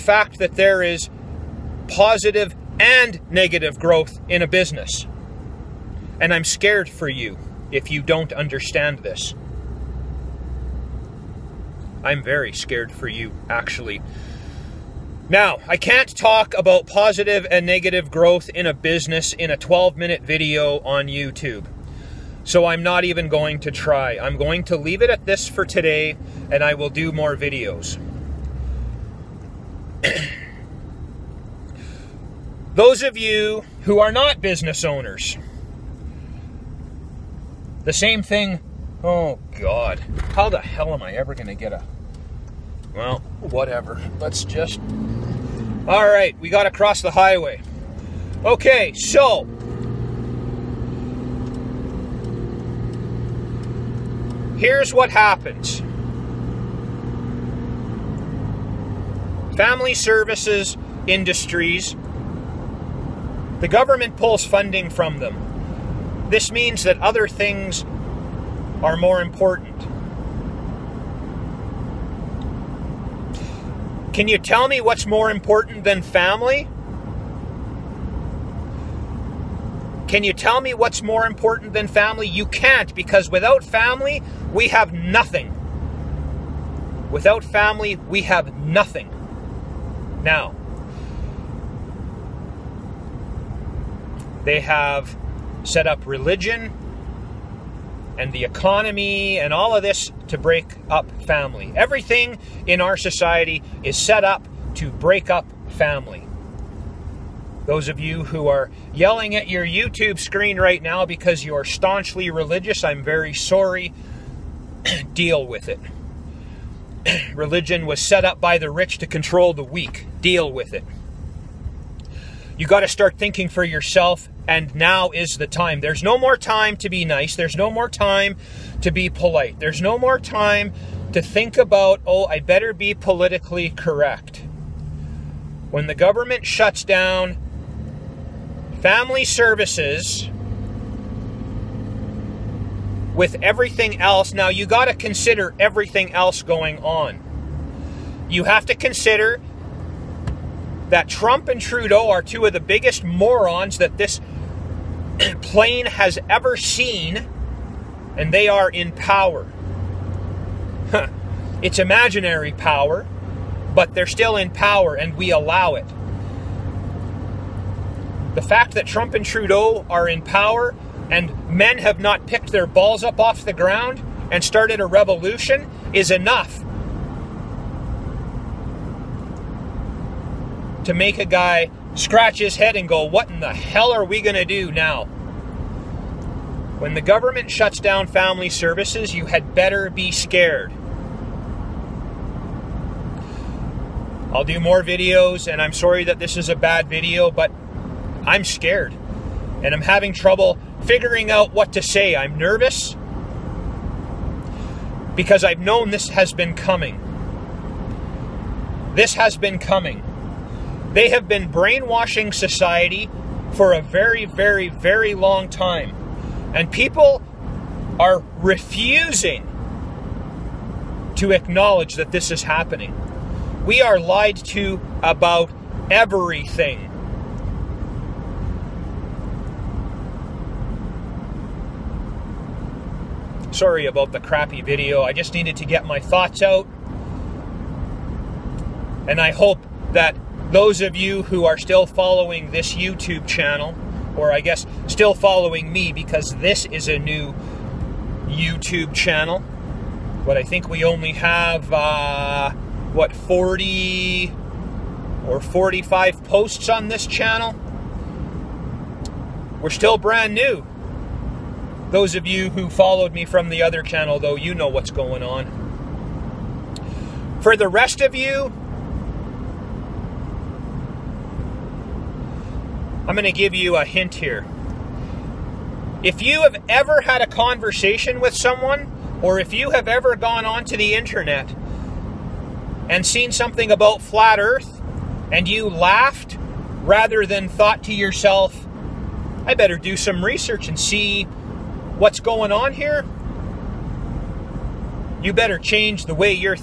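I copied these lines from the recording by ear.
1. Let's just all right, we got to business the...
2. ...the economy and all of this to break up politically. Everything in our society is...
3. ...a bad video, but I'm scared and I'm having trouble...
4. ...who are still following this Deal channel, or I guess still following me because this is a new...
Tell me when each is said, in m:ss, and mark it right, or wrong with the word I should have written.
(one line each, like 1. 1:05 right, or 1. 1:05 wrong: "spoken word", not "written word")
1. 0:44 wrong: "cross", not "business"
2. 1:38 wrong: "family", not "politically"
3. 3:16 right
4. 4:01 wrong: "YouTube", not "Deal".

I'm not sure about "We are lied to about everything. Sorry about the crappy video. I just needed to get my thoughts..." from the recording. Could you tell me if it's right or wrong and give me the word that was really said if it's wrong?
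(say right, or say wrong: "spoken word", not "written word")
right.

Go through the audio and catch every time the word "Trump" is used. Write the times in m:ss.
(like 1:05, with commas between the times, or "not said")
2:31, 2:48.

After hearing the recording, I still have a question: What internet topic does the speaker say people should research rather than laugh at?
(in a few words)
Flat earth.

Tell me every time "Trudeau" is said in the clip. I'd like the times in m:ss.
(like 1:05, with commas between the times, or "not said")
2:31, 2:49.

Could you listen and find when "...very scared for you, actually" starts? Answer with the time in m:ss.
0:12.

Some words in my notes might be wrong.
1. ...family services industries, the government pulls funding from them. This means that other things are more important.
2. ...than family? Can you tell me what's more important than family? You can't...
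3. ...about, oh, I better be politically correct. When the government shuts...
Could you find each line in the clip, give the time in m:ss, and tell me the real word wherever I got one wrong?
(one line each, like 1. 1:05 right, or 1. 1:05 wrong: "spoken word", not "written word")
1. 0:59 right
2. 1:15 right
3. 2:11 right.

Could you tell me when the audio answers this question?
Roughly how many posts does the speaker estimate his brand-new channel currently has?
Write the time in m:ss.
4:13.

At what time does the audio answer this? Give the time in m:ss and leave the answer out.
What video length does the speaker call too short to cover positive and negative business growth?
0:19.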